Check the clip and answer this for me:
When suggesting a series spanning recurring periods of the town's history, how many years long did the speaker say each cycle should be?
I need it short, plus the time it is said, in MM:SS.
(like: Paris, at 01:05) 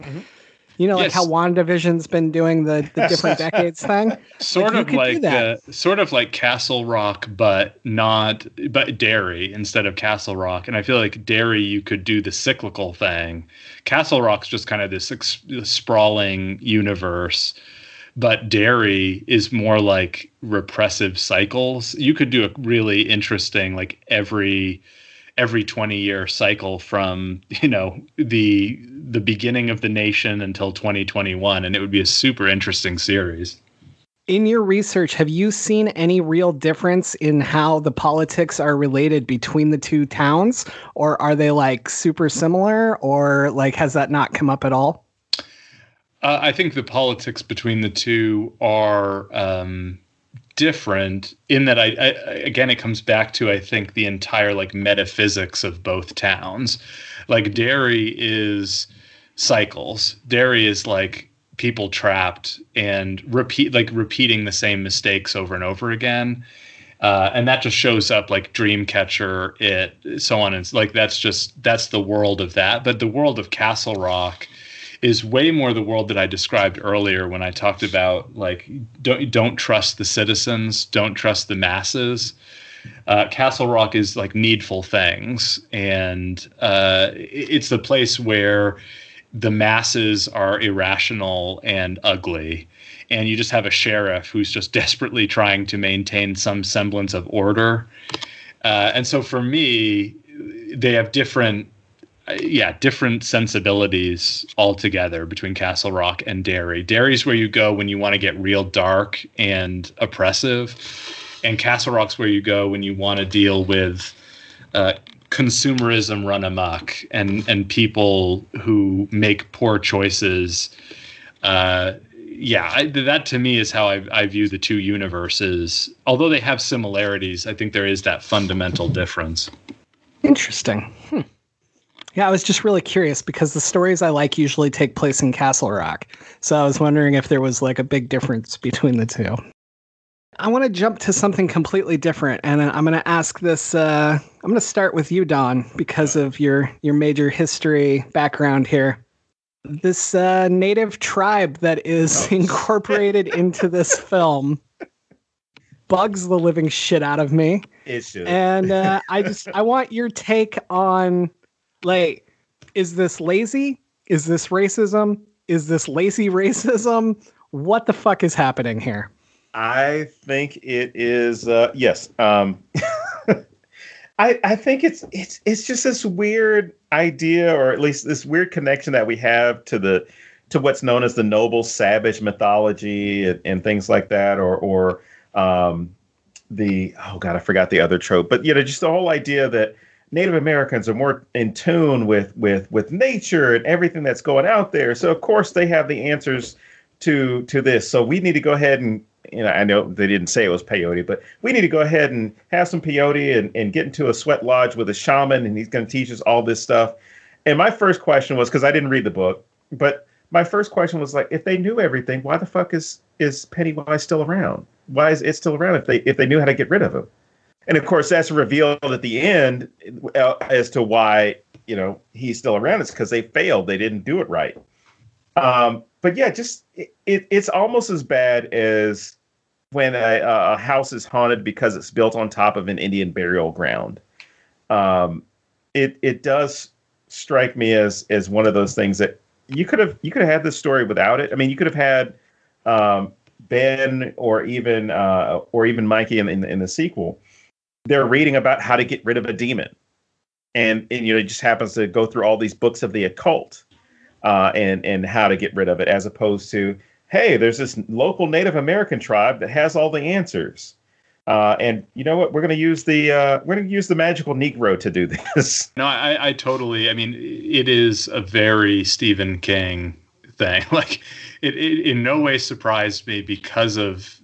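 20, at 00:25.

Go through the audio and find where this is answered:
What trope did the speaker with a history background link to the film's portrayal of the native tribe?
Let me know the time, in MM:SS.
03:01.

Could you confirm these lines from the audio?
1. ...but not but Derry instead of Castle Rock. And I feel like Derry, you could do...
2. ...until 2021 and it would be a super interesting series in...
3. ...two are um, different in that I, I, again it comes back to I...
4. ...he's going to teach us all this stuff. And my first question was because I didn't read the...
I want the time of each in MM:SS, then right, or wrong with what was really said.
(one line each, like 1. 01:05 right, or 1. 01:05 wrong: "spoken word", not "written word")
1. 00:07 right
2. 00:30 right
3. 00:47 right
4. 03:25 right.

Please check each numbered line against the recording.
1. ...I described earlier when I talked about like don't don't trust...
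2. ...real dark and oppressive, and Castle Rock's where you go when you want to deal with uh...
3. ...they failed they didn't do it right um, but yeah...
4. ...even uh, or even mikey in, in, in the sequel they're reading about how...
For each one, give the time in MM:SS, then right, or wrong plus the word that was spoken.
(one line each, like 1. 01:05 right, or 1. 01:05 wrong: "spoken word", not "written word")
1. 01:16 right
2. 01:48 right
3. 03:43 right
4. 04:04 right.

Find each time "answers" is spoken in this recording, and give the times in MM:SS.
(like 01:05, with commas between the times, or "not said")
03:16, 04:20.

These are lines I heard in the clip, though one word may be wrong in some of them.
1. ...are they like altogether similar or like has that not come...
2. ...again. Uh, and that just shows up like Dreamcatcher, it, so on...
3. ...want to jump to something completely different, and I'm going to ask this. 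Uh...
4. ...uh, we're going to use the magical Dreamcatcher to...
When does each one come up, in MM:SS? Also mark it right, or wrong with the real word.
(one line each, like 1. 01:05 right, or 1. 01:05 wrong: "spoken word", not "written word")
1. 00:41 wrong: "super", not "altogether"
2. 01:05 right
3. 02:20 right
4. 04:23 wrong: "Negro", not "Dreamcatcher".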